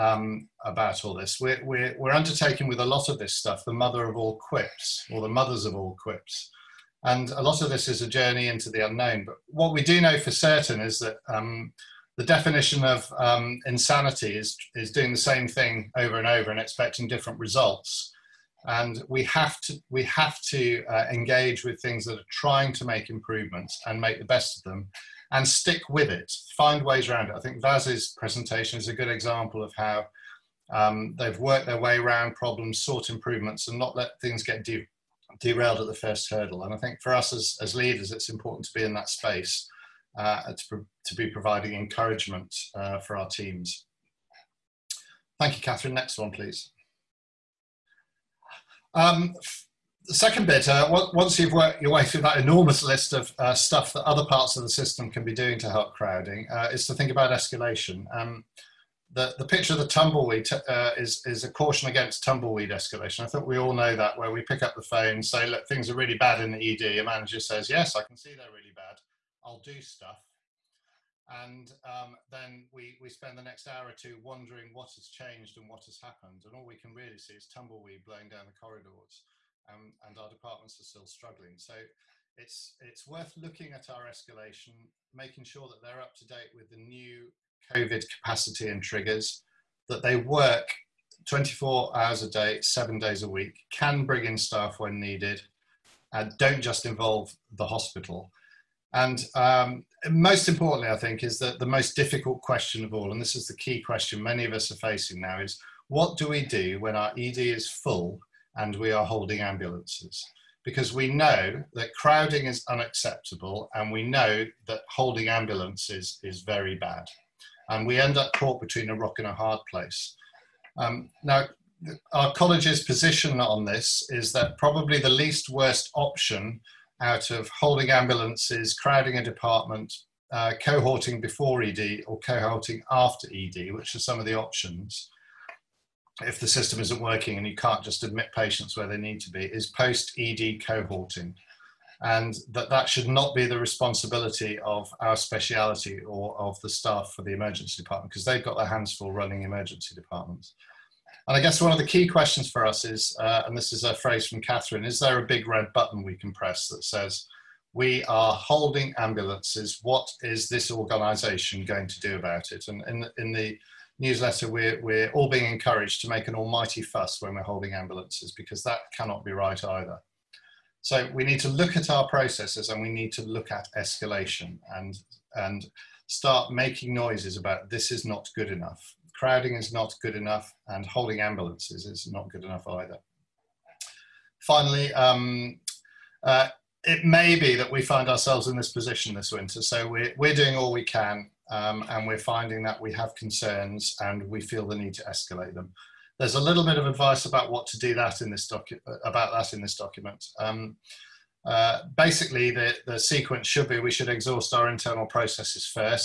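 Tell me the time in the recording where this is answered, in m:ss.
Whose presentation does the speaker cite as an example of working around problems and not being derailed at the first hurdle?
0:27.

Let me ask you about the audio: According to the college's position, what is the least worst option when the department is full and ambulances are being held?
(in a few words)
post ED cohorting.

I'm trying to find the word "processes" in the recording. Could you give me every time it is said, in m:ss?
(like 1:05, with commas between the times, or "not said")
2:52, 3:25.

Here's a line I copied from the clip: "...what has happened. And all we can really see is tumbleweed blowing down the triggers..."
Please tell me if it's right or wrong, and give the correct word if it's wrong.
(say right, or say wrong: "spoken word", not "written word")
wrong: "corridors", not "triggers".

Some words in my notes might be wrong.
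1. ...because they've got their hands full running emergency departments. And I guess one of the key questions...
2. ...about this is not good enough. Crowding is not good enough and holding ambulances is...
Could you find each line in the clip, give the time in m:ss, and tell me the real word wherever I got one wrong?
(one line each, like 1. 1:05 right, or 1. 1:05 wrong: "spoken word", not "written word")
1. 2:28 right
2. 2:57 right.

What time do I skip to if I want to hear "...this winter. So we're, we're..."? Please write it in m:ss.
3:09.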